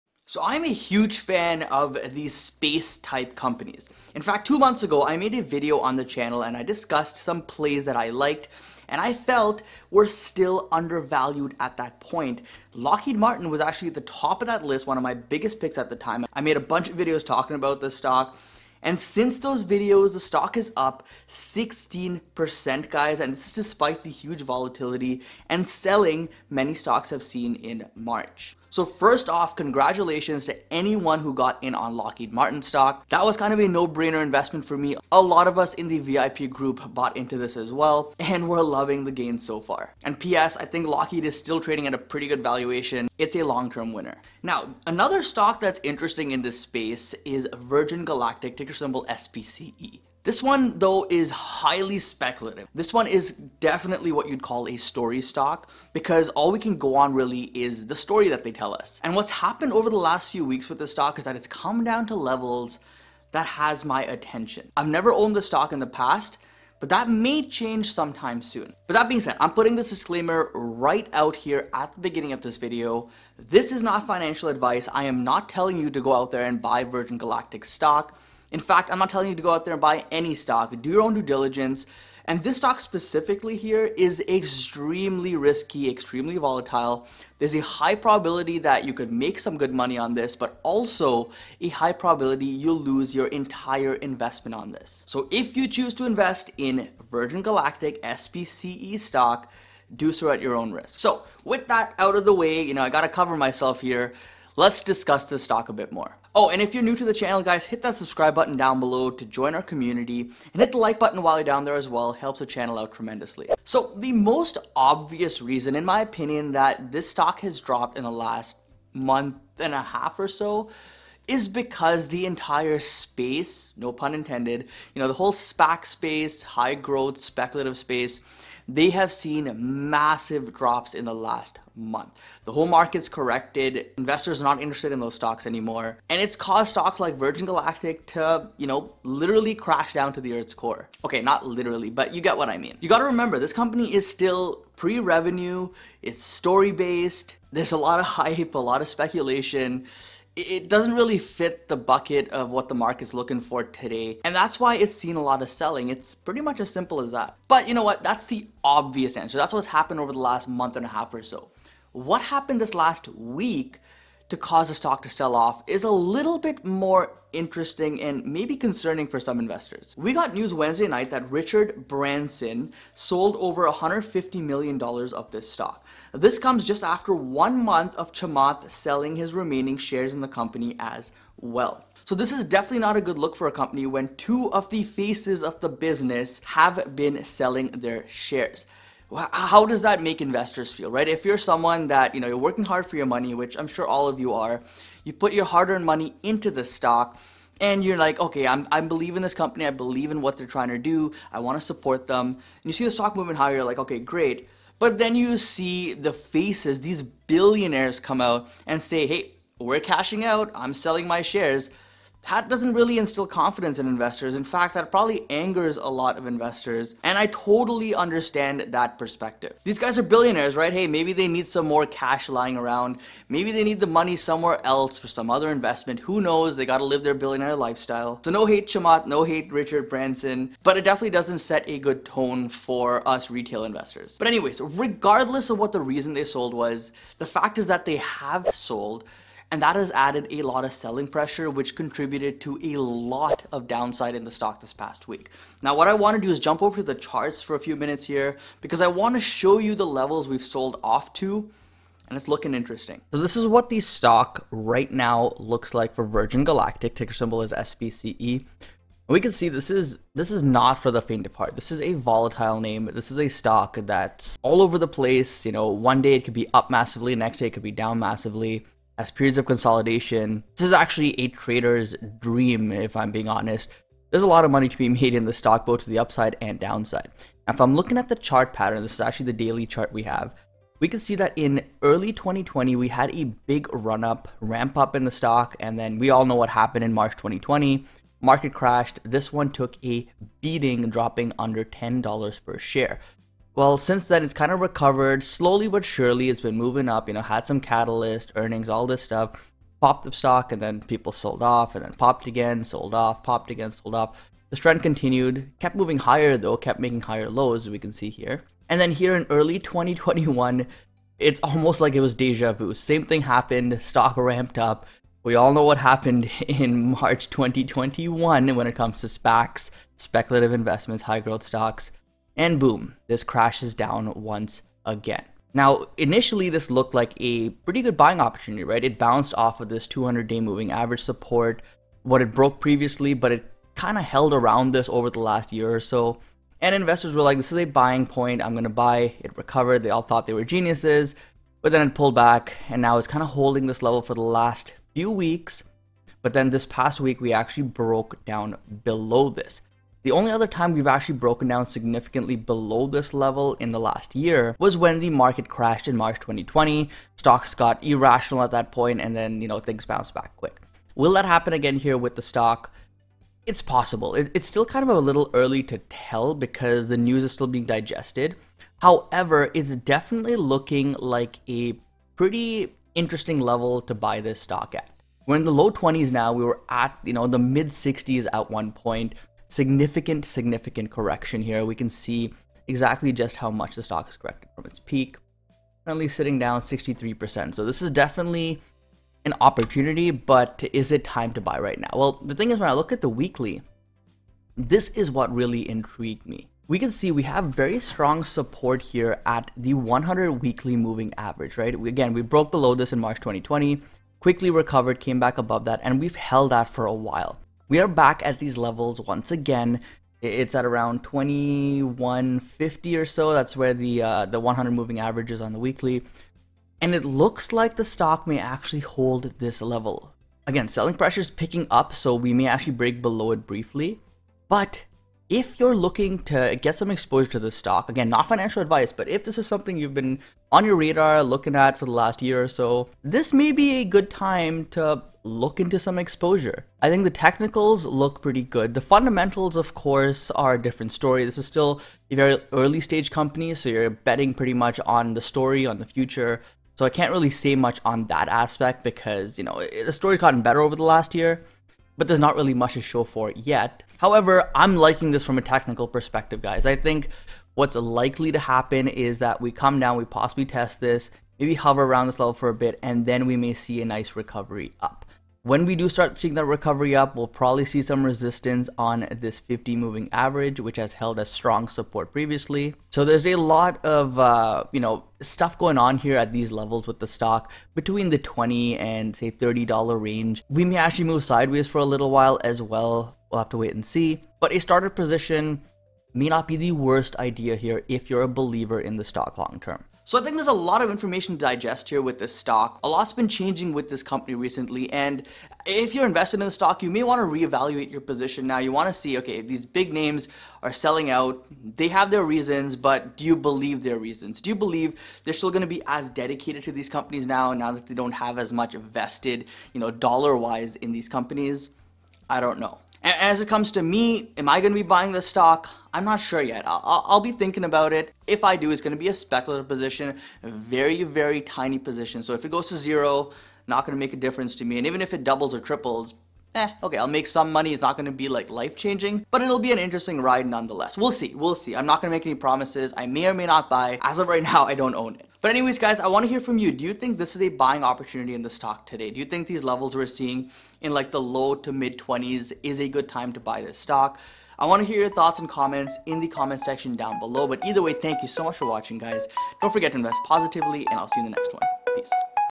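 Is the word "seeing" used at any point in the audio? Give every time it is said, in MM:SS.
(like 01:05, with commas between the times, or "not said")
07:46, 09:00.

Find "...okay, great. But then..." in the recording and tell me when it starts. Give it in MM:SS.
03:23.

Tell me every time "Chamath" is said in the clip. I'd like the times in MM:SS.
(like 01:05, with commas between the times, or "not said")
02:58, 03:48.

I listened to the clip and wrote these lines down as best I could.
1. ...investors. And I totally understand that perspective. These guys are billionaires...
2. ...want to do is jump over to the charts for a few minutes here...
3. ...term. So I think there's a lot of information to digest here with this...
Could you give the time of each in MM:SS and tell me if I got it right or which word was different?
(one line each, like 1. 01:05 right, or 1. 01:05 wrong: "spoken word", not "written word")
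1. 03:36 right
2. 04:05 right
3. 08:09 right.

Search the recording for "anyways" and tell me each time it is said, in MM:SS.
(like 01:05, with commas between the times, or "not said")
03:54, 08:55.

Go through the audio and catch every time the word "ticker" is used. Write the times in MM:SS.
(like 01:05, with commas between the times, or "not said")
00:48, 04:16.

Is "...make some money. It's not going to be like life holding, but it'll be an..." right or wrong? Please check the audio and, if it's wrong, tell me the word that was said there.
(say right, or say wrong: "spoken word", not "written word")
wrong: "changing", not "holding".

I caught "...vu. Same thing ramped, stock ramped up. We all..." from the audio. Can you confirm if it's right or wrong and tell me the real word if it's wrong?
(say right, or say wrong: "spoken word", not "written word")
wrong: "happened", not "ramped".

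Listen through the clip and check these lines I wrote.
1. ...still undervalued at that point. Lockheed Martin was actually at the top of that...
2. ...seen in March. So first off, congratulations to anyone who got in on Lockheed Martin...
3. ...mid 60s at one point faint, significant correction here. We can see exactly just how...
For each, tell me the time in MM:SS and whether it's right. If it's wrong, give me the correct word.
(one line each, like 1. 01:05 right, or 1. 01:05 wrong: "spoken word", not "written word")
1. 00:10 right
2. 00:27 right
3. 06:17 wrong: "significant", not "faint".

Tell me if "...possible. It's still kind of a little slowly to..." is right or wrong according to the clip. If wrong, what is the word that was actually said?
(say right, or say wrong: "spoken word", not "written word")
wrong: "early", not "slowly".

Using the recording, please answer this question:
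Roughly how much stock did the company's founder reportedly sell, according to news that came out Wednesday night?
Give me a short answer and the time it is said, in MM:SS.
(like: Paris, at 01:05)
$150 million, at 02:53.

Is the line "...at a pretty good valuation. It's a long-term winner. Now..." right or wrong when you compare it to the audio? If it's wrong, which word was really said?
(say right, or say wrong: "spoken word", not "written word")
right.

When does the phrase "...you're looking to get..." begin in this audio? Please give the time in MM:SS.
07:05.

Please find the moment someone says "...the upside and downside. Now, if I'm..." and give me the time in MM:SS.
04:35.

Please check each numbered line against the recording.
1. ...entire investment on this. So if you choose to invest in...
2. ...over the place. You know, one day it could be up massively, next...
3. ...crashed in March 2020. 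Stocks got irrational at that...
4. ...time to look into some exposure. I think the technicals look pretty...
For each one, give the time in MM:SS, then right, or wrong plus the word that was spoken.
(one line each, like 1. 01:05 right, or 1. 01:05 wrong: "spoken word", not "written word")
1. 01:33 right
2. 04:24 right
3. 05:55 right
4. 07:14 right.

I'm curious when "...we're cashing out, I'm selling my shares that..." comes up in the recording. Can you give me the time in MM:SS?
03:29.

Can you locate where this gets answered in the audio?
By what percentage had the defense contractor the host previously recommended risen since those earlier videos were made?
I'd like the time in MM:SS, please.
00:21.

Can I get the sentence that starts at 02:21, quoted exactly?
Okay, not literally, but you get what I mean.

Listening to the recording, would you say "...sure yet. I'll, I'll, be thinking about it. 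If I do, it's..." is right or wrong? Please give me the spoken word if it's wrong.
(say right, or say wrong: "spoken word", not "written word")
right.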